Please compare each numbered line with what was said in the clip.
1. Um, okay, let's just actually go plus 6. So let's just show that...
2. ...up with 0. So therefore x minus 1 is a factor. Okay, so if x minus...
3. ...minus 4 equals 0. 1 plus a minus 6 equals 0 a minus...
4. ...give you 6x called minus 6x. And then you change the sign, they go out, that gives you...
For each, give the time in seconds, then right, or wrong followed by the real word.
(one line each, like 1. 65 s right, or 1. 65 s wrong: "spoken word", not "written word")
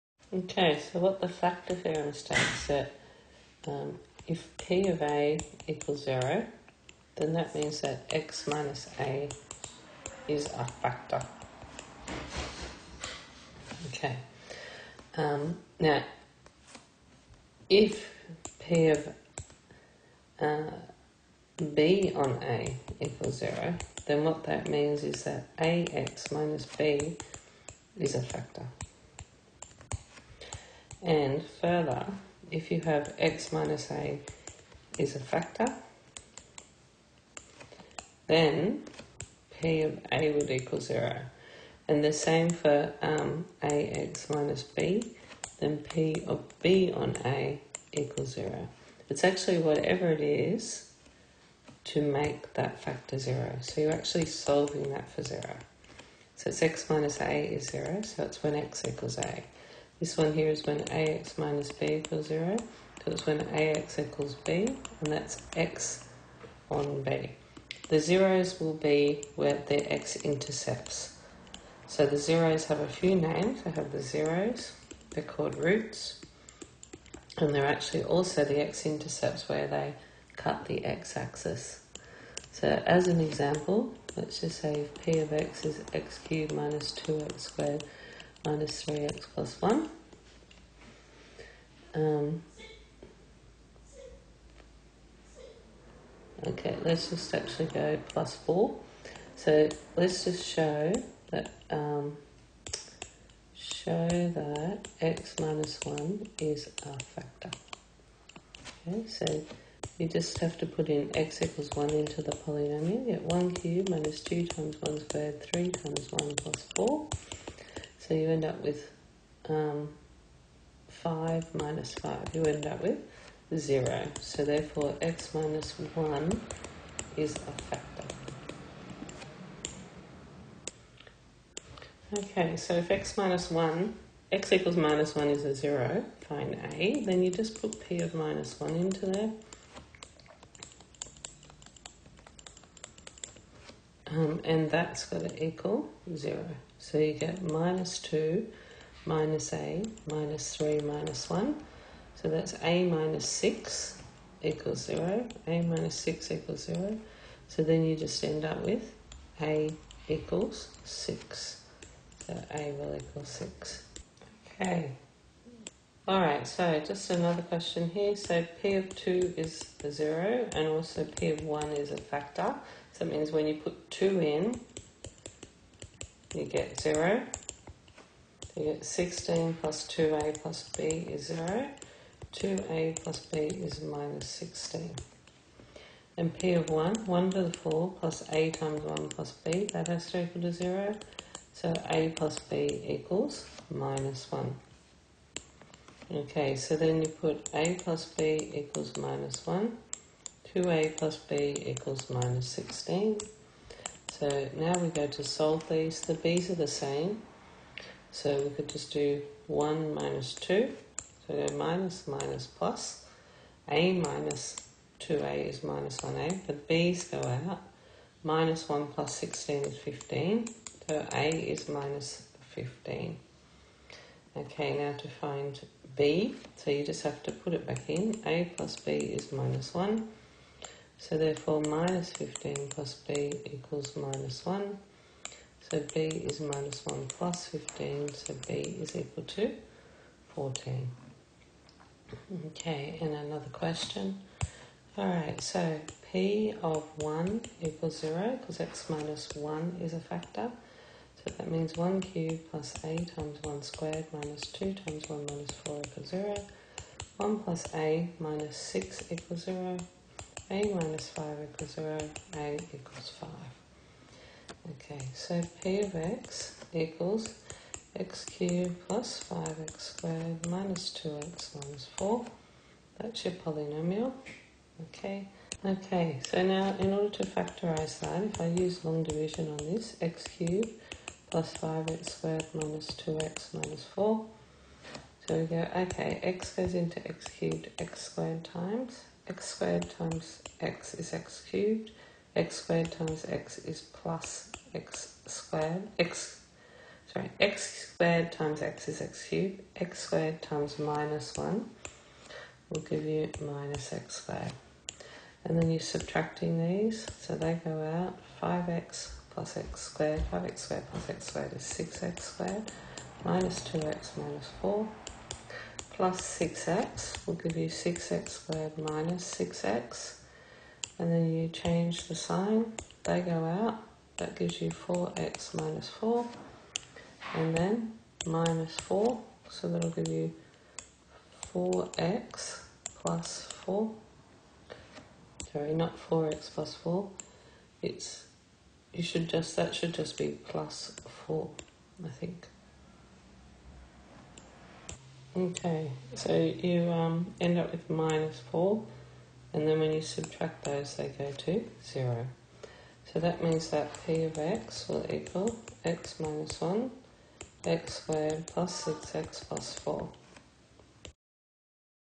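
1. 91 s wrong: "4", not "6"
2. 122 s right
3. 255 s right
4. 317 s wrong: "squared", not "called".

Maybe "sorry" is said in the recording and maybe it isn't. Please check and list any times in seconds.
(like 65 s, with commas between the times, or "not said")
297 s, 335 s.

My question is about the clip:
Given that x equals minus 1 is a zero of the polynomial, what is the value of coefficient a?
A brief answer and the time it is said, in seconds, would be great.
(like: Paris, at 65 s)
6, at 159 s.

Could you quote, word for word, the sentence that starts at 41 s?
And the same for um, ax minus b, then p of b on a equals 0.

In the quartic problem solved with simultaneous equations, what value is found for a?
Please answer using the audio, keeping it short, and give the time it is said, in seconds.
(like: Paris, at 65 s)
-15, at 221 s.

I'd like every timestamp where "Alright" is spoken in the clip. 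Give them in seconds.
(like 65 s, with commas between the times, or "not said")
166 s, 244 s.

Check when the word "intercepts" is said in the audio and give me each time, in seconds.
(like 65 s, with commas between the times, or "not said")
69 s, 78 s.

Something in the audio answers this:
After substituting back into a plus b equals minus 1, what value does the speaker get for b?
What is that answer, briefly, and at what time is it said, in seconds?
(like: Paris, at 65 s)
14, at 238 s.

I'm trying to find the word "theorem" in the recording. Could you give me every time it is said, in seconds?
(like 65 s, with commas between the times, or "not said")
1 s.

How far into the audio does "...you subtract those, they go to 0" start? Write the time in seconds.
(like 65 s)
349 s.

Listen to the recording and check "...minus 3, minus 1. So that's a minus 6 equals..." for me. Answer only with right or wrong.
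right.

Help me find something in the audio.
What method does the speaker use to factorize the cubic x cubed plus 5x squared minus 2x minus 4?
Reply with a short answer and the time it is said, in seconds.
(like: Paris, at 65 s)
long division, at 278 s.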